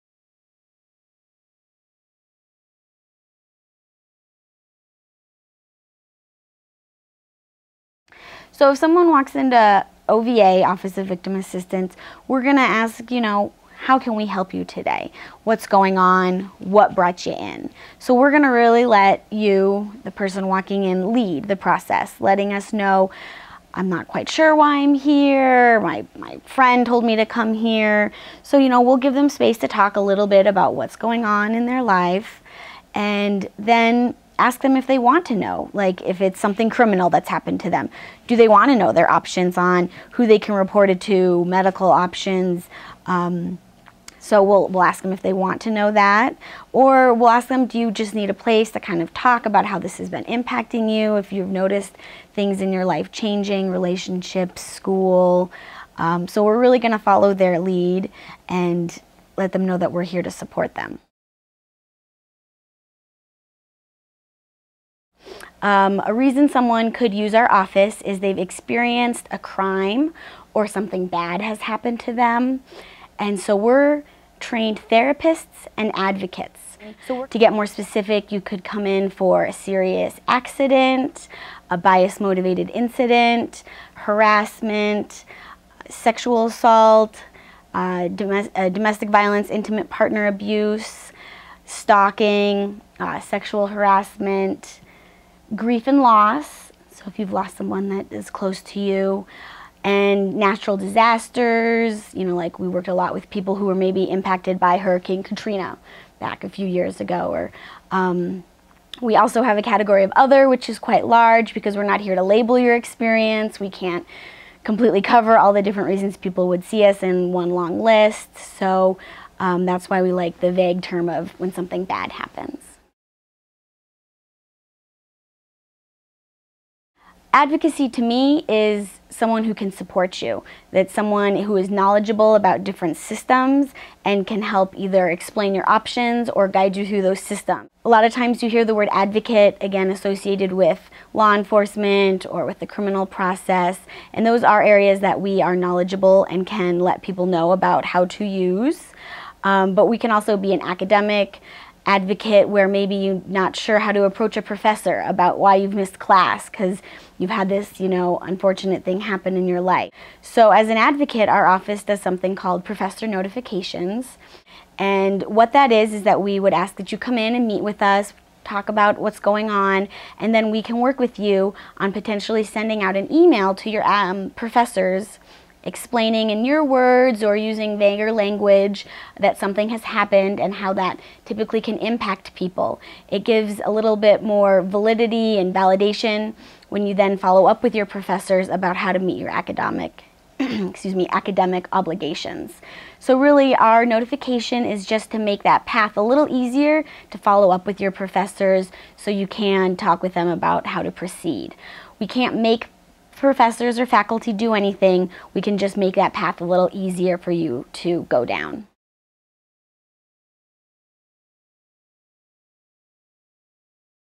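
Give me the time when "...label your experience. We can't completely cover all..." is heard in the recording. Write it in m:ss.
1:52.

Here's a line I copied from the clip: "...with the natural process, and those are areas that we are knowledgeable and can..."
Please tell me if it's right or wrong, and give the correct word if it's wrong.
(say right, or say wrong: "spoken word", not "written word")
wrong: "criminal", not "natural".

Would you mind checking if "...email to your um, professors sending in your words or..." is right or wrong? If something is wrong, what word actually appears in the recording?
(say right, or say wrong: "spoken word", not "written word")
wrong: "explaining", not "sending".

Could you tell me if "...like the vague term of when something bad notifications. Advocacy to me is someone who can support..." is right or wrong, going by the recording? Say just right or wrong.
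wrong.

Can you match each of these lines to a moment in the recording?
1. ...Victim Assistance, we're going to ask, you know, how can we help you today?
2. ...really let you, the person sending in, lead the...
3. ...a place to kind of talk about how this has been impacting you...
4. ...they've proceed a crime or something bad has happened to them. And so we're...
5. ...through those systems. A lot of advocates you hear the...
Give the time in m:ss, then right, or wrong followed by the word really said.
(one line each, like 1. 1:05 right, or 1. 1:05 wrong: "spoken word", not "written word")
1. 0:11 right
2. 0:18 wrong: "walking", not "sending"
3. 0:48 right
4. 1:08 wrong: "experienced", not "proceed"
5. 2:16 wrong: "times", not "advocates".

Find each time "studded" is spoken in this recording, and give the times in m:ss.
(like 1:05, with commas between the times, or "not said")
not said.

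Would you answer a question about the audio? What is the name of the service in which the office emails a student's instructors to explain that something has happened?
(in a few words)
professor notifications.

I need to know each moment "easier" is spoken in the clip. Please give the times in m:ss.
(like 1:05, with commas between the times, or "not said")
3:16, 3:26.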